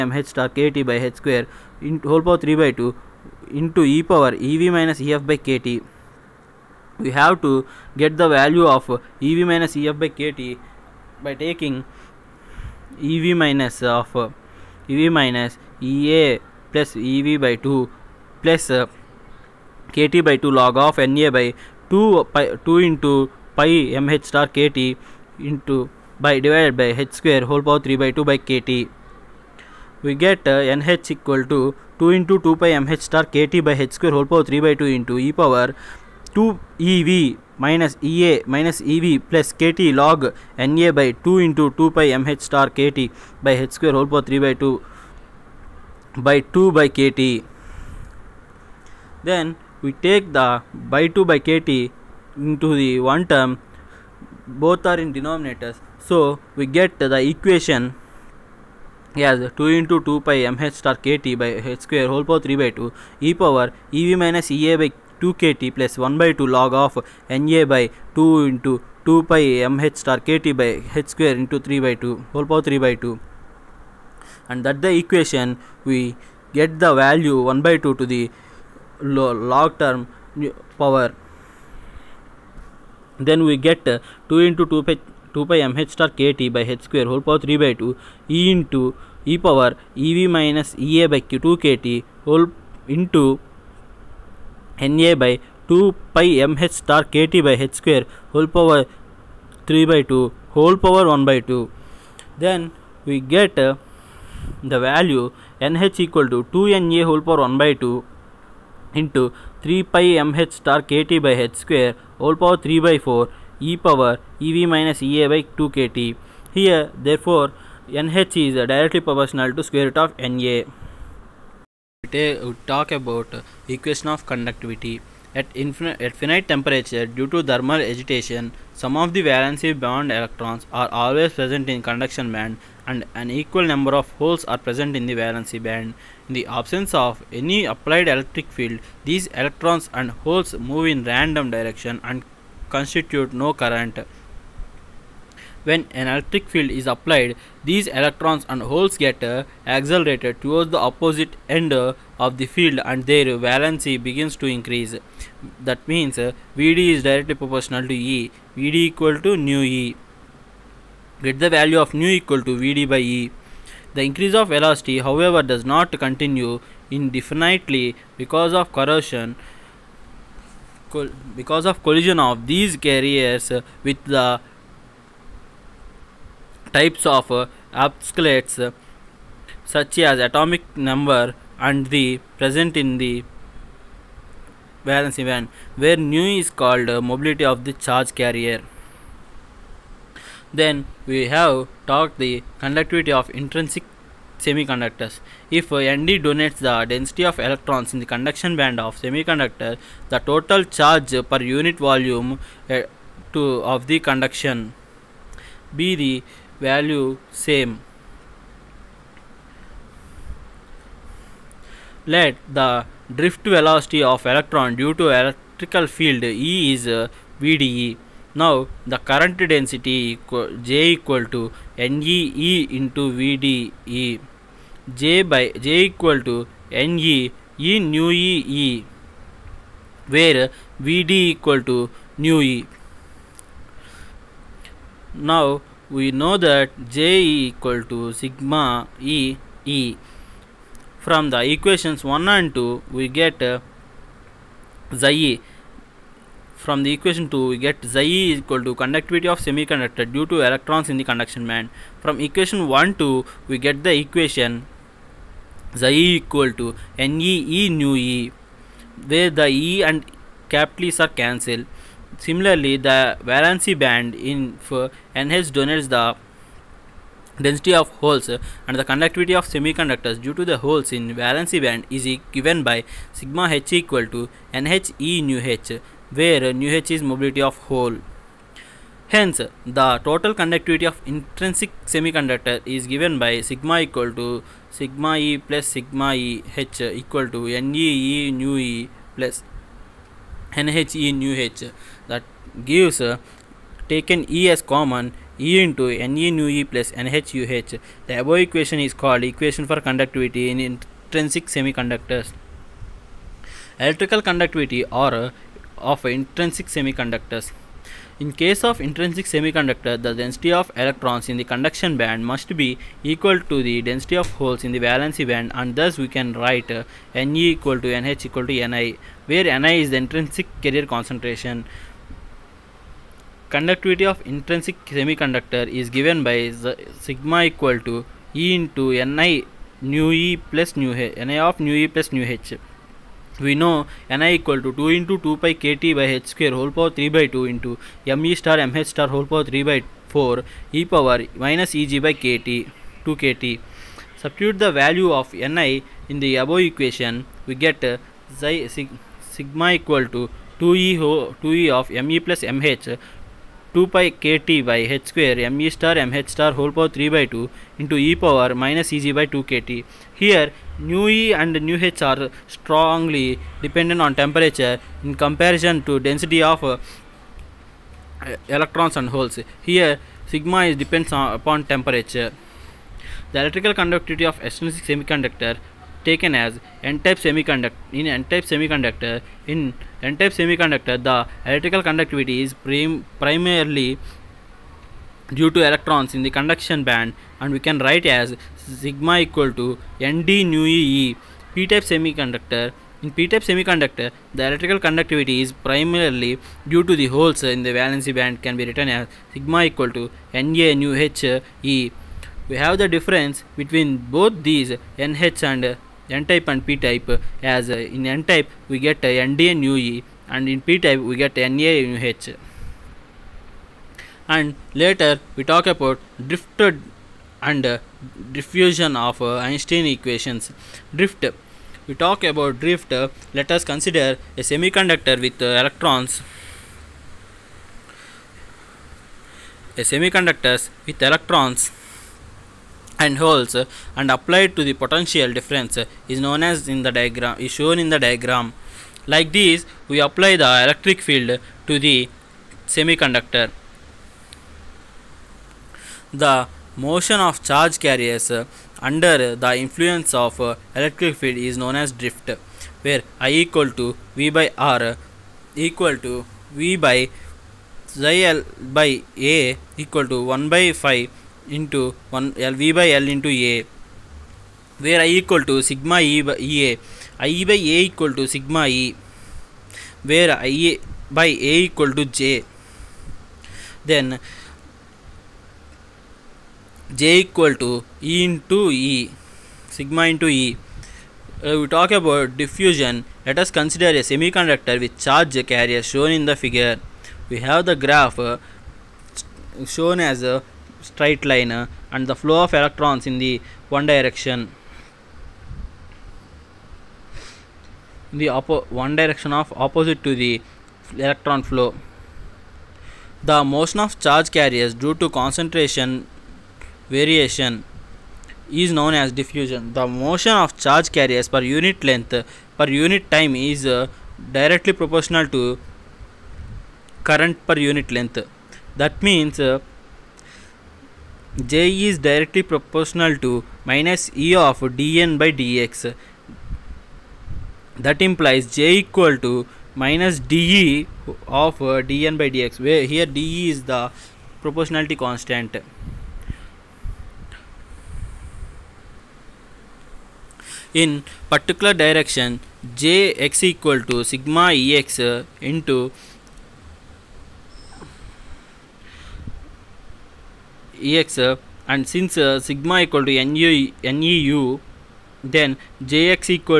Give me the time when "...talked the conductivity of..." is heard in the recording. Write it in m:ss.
3:11.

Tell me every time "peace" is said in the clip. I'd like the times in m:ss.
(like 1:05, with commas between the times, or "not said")
not said.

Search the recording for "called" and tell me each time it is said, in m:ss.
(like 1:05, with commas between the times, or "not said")
3:06, 4:58.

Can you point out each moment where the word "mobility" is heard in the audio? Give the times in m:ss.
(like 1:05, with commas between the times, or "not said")
3:07, 4:37.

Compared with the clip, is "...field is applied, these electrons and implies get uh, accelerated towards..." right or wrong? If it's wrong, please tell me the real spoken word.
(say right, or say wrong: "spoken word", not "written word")
wrong: "holes", not "implies".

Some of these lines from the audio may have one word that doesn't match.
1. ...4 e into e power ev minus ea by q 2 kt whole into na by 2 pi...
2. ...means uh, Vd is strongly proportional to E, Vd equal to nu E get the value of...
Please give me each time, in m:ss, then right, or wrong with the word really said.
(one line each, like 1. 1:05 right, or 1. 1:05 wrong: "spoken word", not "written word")
1. 1:27 wrong: "2", not "4"
2. 2:35 wrong: "directly", not "strongly".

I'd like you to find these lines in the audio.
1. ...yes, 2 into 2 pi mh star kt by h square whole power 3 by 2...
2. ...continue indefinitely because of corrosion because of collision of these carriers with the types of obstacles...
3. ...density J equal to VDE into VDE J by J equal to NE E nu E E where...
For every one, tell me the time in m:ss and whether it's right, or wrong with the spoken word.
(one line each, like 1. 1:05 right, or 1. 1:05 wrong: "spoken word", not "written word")
1. 0:59 right
2. 2:46 right
3. 3:39 wrong: "NEE", not "VDE".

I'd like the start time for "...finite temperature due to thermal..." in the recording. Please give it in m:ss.
2:06.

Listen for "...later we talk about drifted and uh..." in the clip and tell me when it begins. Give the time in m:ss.
6:54.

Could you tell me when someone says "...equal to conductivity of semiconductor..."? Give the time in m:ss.
4:08.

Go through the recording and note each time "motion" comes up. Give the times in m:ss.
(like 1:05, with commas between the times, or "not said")
7:26, 8:23, 8:29.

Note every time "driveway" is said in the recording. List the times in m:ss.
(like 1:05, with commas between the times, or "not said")
not said.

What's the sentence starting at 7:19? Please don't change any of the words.
Like this, we apply the electric field to the semiconductor.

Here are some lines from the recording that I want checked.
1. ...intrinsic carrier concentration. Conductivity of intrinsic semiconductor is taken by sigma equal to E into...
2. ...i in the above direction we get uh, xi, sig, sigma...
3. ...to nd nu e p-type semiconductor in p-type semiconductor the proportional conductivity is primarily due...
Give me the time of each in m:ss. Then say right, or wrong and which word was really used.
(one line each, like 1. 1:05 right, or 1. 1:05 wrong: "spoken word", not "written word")
1. 5:19 wrong: "given", not "taken"
2. 5:45 wrong: "equation", not "direction"
3. 6:29 wrong: "electrical", not "proportional".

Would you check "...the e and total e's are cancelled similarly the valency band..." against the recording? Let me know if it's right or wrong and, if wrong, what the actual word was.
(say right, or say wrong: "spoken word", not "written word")
wrong: "capital", not "total".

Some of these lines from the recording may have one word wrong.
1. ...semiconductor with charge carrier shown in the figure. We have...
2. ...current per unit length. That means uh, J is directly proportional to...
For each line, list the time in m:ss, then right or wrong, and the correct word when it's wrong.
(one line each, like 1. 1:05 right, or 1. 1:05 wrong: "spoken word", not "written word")
1. 8:04 right
2. 8:37 right.